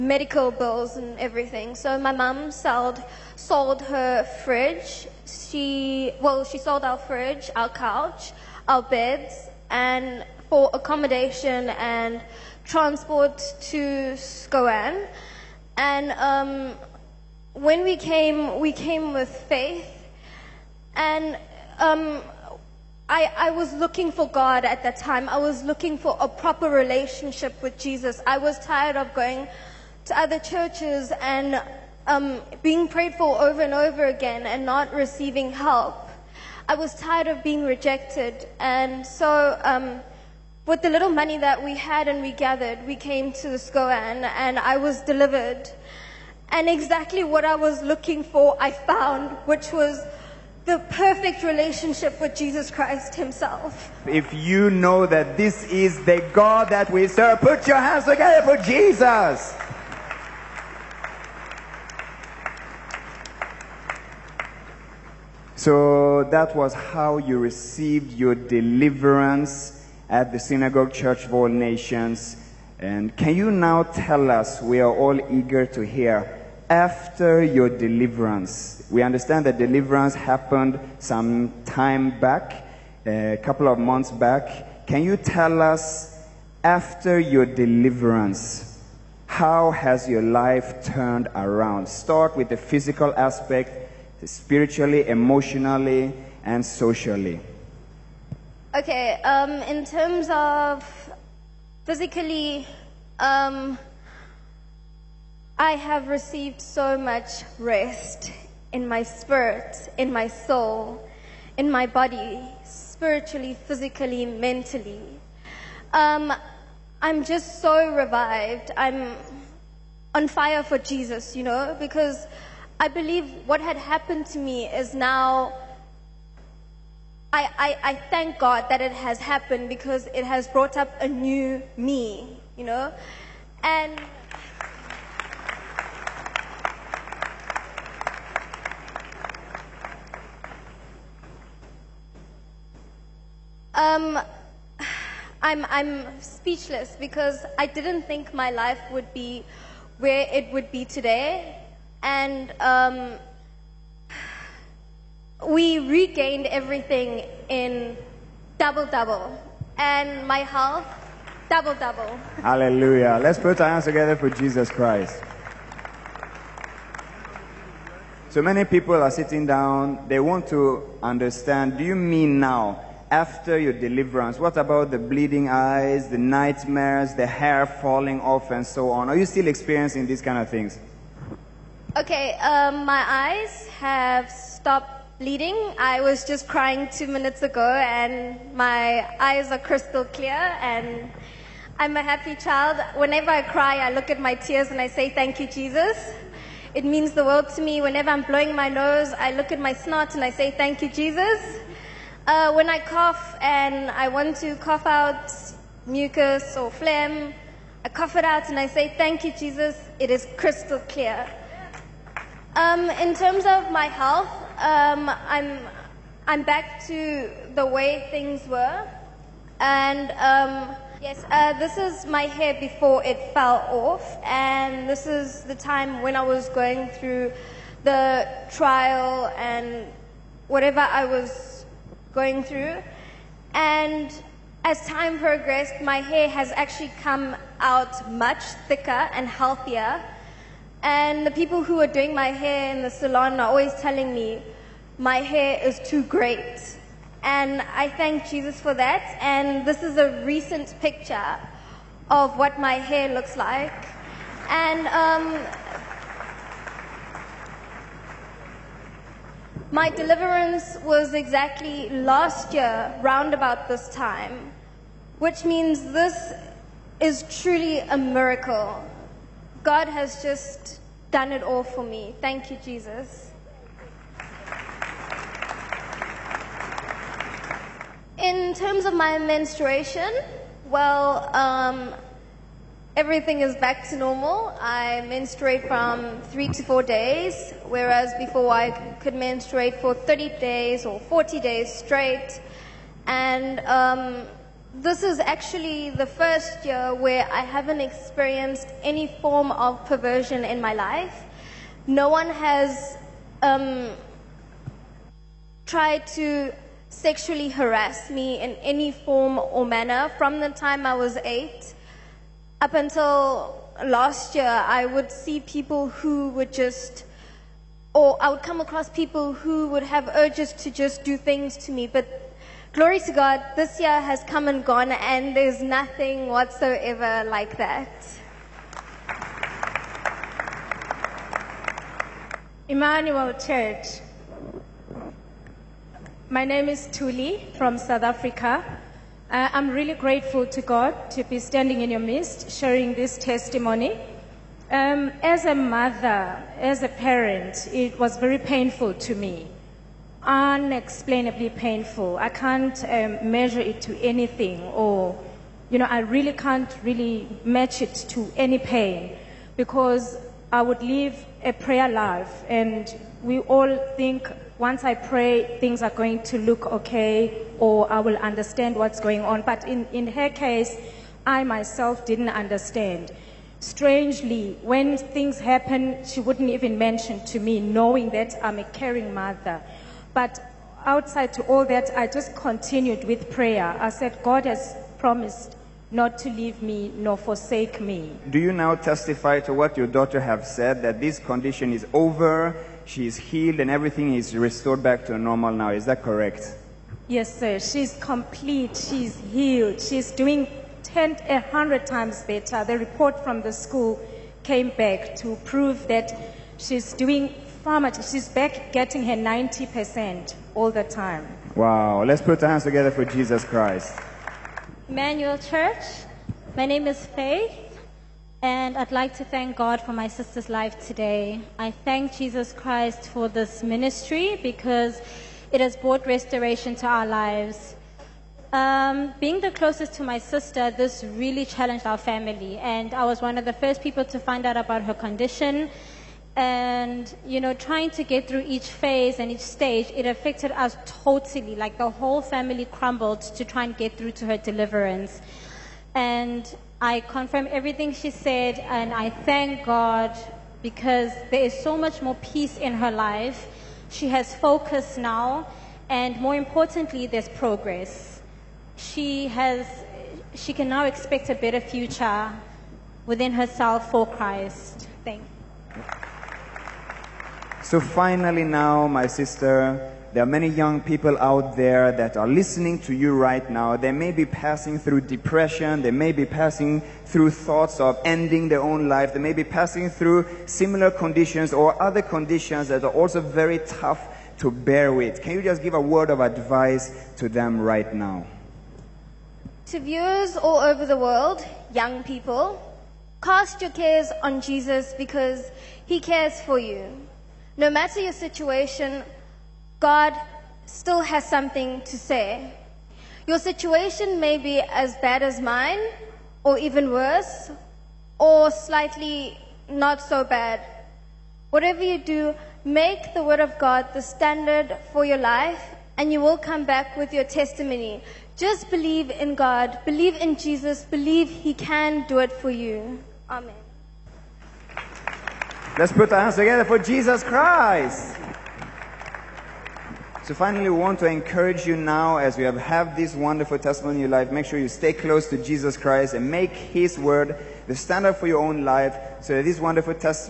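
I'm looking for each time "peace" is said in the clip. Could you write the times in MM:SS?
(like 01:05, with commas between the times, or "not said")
07:32.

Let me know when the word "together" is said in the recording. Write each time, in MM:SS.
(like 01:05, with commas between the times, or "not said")
00:58, 02:43, 06:52, 08:46.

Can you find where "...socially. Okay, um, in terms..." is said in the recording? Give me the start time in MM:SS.
01:36.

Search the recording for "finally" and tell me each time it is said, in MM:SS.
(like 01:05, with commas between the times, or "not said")
07:47, 08:50.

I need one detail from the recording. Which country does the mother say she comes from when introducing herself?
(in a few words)
South Africa.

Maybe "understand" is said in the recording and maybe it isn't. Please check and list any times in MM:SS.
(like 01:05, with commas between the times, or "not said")
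01:19, 02:50, 06:08, 06:12.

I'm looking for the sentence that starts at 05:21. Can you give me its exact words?
But glory to God, this year has come and gone, and there's nothing whatsoever like that.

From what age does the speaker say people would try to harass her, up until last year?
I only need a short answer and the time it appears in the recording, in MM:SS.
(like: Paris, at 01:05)
8, at 05:11.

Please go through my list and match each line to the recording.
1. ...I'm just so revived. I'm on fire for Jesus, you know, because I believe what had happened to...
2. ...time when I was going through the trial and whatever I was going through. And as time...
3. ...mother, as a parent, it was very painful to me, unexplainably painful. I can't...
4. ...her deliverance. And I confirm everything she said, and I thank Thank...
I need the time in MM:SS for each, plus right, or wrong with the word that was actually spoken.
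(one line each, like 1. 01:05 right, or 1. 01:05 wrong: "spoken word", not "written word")
1. 01:57 right
2. 03:45 right
3. 05:45 right
4. 07:24 wrong: "God", not "Thank".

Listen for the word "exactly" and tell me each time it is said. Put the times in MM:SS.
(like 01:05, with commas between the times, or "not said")
00:46, 04:21.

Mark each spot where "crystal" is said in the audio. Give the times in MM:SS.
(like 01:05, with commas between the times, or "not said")
03:09, 03:30.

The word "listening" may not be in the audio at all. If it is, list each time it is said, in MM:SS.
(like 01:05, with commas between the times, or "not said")
07:52.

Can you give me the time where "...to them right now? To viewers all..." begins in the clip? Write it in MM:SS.
08:07.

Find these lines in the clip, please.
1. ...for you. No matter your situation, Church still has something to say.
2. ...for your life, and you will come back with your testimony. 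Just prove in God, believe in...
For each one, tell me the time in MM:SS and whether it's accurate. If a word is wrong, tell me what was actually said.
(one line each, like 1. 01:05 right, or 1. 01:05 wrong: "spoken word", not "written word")
1. 08:16 wrong: "God", not "Church"
2. 08:34 wrong: "believe", not "prove".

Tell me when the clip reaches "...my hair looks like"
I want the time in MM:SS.
04:12.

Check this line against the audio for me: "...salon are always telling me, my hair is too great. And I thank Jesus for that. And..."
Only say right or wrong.
right.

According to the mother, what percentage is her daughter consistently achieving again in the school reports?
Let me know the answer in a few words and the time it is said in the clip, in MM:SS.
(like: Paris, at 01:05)
90%, at 06:49.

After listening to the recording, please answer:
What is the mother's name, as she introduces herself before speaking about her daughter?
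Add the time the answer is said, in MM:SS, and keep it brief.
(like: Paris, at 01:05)
Tuli, at 05:36.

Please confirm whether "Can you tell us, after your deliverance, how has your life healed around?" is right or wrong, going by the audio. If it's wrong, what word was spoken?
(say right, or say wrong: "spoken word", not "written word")
wrong: "turned", not "healed".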